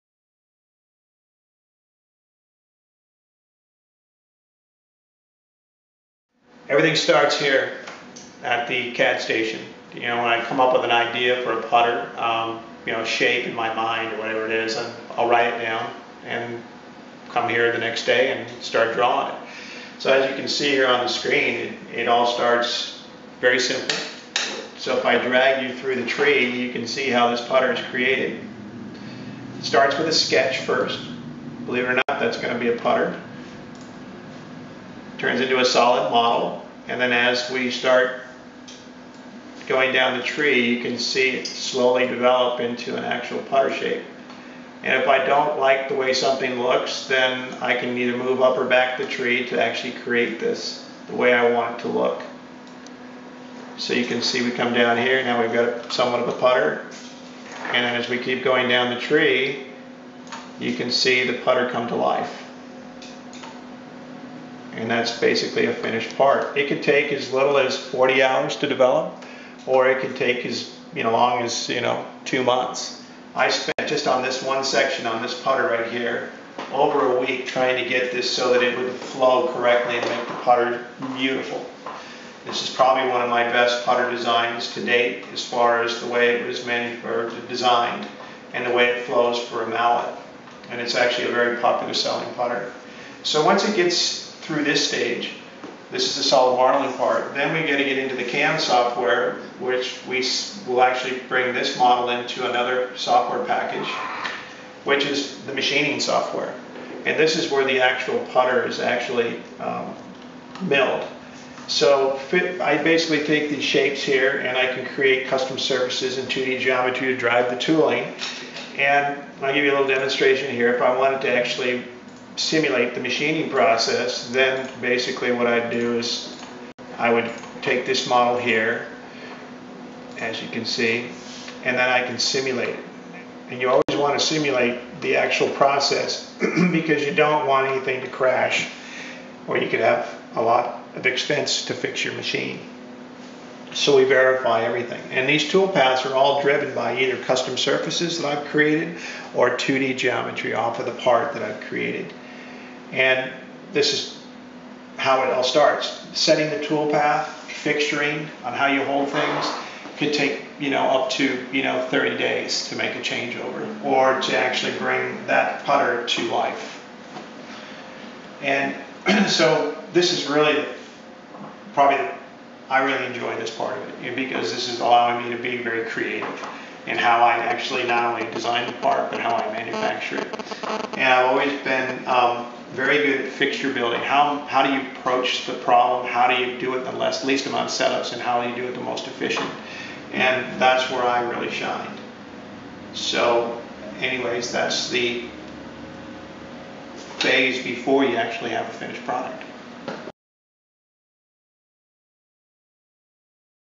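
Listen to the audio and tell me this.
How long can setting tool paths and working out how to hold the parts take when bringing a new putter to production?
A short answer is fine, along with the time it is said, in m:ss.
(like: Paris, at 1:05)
30 days, at 2:41.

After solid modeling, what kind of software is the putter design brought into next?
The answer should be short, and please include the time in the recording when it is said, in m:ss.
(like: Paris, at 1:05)
machining software, at 1:45.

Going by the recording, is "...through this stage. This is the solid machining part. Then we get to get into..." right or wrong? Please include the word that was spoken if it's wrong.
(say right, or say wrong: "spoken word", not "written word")
wrong: "modeling", not "machining".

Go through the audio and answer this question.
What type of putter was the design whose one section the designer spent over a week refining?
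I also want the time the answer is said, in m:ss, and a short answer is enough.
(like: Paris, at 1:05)
mallet, at 1:29.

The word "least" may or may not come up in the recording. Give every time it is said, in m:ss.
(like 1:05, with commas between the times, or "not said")
3:07.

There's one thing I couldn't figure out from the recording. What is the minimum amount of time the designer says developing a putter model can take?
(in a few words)
40 hours.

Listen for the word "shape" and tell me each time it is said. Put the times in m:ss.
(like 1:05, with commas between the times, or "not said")
0:13, 0:43, 1:53.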